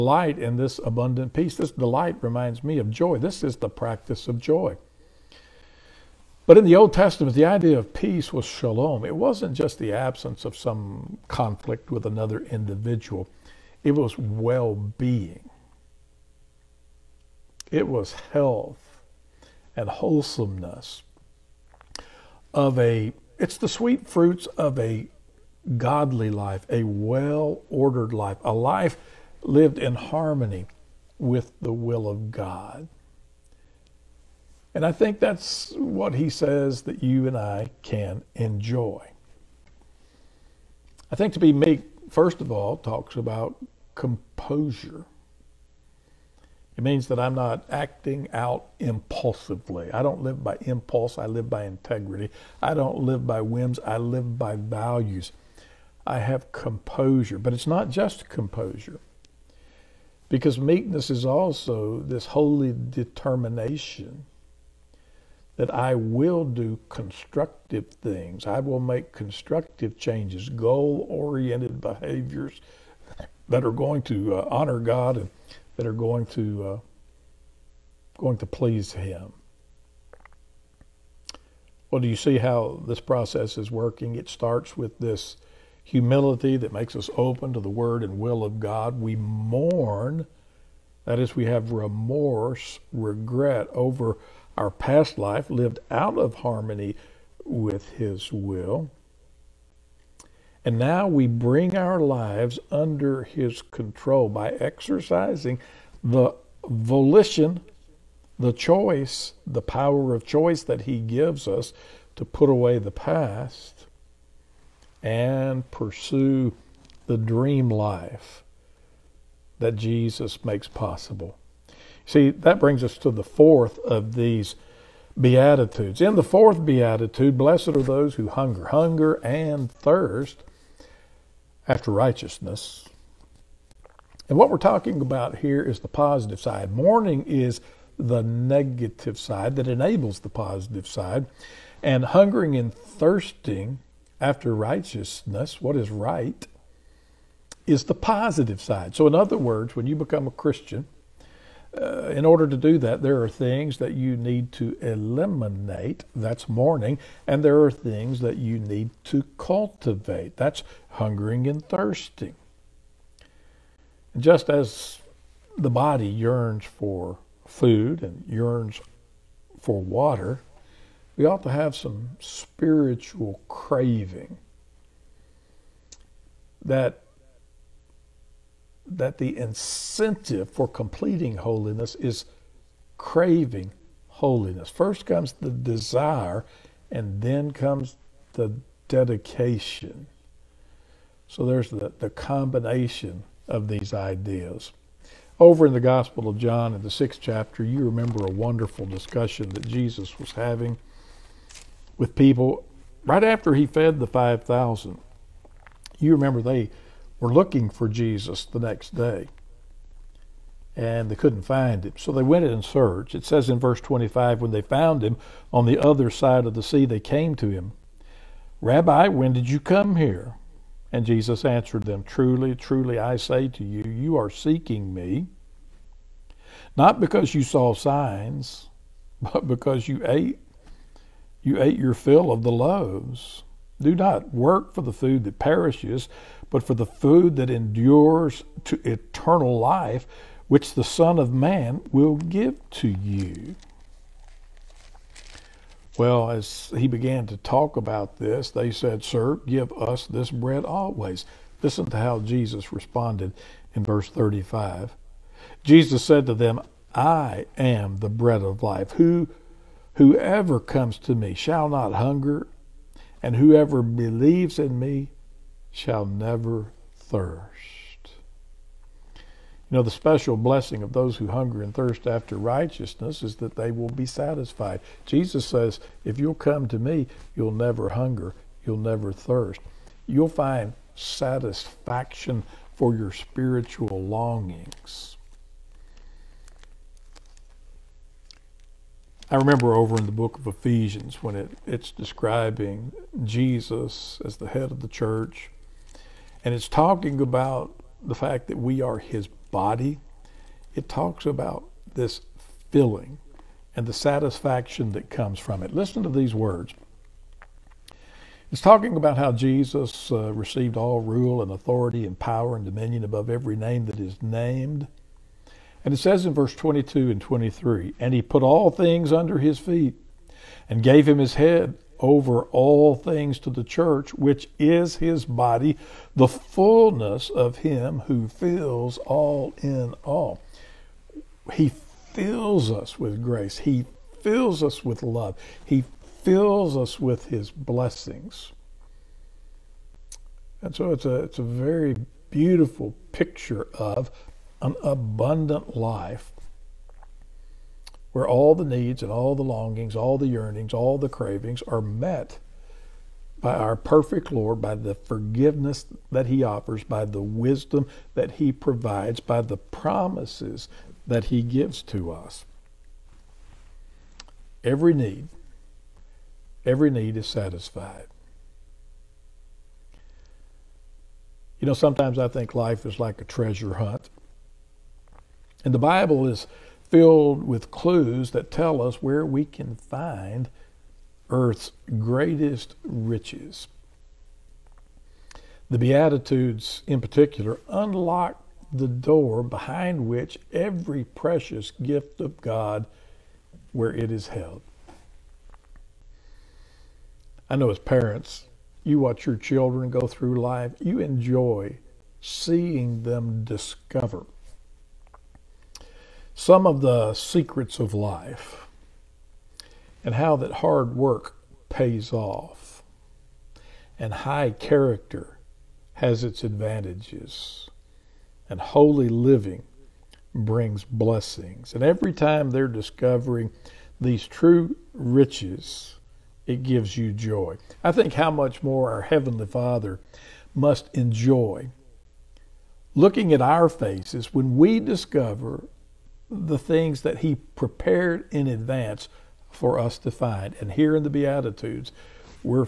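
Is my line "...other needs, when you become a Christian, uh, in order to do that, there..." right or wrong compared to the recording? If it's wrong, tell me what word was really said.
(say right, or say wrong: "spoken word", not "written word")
wrong: "words", not "needs".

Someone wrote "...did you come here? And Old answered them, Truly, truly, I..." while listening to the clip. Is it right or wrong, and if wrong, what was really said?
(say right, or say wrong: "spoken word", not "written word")
wrong: "Jesus", not "Old".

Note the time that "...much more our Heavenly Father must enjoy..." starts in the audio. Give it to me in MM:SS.
07:08.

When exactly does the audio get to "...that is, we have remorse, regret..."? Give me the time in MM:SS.
01:31.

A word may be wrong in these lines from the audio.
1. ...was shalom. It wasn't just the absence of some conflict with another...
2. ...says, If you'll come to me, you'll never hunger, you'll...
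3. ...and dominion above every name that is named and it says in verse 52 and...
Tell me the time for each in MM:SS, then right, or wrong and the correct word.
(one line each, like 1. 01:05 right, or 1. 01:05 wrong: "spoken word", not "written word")
1. 00:08 right
2. 04:35 right
3. 05:12 wrong: "22", not "52".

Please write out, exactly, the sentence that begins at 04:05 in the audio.
Well, as he began to talk about this, they said, Sir, give us this bread always.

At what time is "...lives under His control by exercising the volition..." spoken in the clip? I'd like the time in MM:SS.
01:41.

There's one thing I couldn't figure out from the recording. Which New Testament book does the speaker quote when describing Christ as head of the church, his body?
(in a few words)
Ephesians.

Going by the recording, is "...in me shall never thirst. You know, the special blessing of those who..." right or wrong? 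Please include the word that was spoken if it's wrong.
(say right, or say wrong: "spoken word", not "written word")
right.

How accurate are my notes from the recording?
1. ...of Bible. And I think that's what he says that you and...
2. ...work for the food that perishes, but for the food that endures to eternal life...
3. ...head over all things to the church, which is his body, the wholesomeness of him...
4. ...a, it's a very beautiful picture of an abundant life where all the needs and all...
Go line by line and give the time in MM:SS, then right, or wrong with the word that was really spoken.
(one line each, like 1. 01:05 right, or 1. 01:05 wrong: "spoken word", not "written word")
1. 00:32 wrong: "God", not "Bible"
2. 03:54 right
3. 05:21 wrong: "fullness", not "wholesomeness"
4. 05:41 right.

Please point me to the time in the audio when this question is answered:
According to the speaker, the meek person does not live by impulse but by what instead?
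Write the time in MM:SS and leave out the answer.
00:51.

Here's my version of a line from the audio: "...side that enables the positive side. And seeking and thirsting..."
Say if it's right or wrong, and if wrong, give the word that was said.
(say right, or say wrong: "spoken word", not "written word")
wrong: "hungering", not "seeking".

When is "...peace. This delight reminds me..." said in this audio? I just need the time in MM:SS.
00:01.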